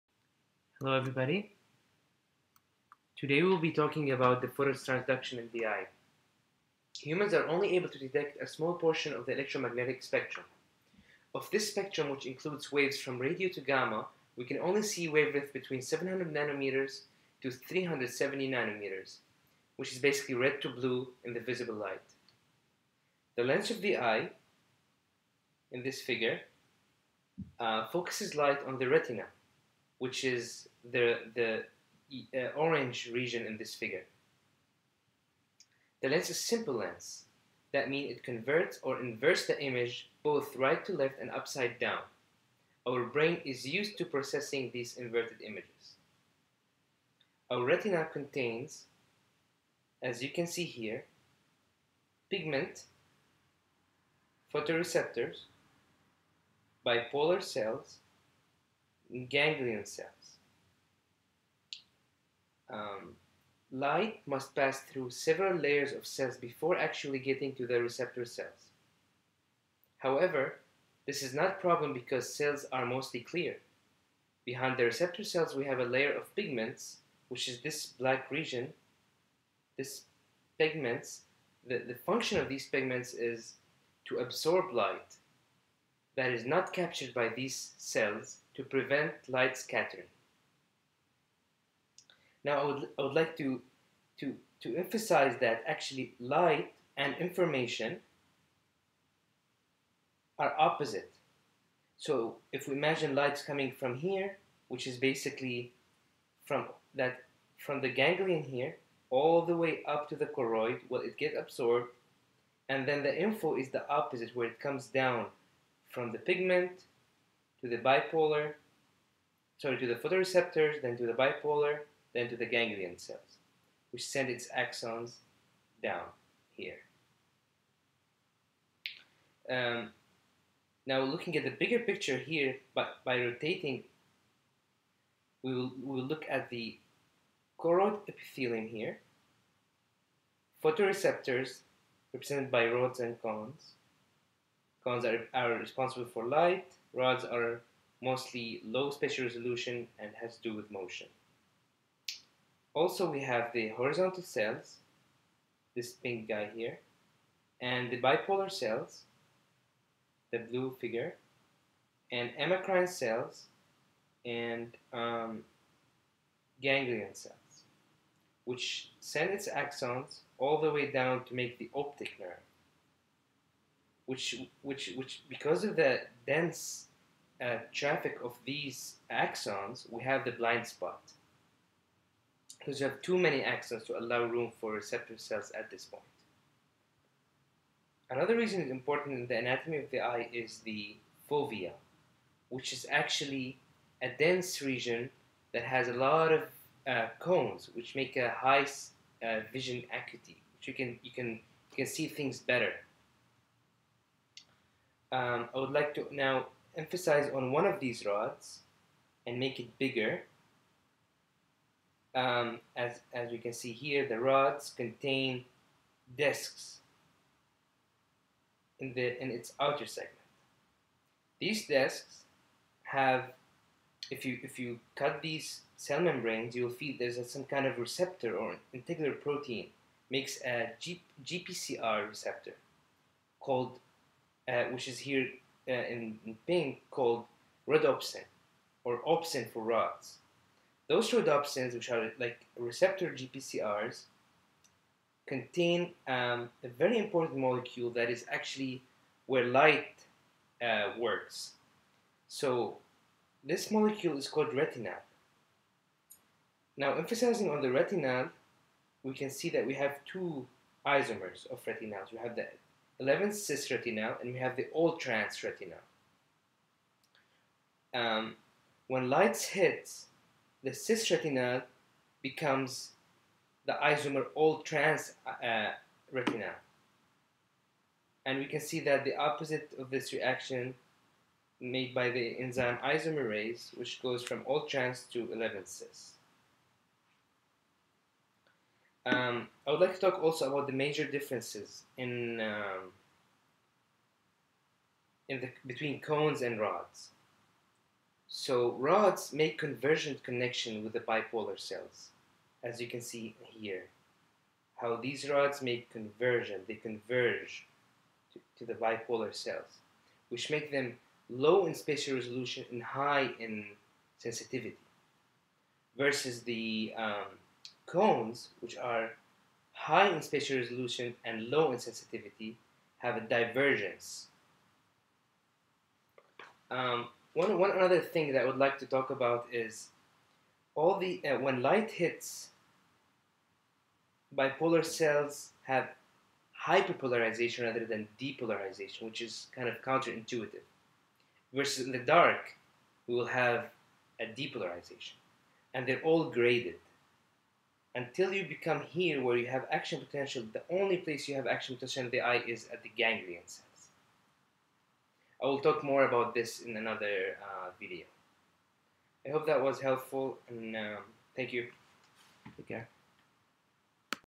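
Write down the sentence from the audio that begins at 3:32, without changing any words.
Um, as, as we can see here, the rods contain discs in, the, in its outer segment.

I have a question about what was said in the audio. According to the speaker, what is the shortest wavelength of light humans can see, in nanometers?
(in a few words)
370 nanometers.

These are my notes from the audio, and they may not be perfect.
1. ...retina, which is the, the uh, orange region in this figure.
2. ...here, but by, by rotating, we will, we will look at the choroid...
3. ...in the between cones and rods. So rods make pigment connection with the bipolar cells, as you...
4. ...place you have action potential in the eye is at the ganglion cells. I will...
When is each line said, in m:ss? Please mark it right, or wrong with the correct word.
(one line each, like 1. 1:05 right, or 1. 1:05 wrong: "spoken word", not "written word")
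1. 0:28 right
2. 2:12 right
3. 4:55 wrong: "convergent", not "pigment"
4. 5:50 right.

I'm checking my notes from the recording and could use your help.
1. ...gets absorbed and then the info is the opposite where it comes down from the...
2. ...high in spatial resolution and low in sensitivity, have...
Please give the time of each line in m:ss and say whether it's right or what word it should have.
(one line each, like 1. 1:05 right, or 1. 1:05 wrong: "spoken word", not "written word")
1. 1:51 right
2. 5:19 right.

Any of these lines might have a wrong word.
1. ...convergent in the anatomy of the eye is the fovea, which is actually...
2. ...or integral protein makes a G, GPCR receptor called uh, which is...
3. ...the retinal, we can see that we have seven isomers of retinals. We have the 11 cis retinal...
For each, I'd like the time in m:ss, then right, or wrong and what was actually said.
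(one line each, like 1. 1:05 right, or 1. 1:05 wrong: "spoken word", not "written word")
1. 3:08 wrong: "important", not "convergent"
2. 3:48 right
3. 4:17 wrong: "two", not "seven".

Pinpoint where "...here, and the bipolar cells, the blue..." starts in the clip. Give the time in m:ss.
2:36.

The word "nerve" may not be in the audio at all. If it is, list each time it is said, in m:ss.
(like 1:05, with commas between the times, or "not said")
2:52.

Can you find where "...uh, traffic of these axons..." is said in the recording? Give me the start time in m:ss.
2:57.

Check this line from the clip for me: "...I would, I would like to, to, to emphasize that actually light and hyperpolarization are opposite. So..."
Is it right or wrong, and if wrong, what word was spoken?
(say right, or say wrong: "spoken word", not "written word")
wrong: "information", not "hyperpolarization".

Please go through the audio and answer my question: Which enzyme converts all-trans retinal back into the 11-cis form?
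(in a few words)
isomerase.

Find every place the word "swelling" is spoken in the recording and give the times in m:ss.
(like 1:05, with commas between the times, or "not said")
not said.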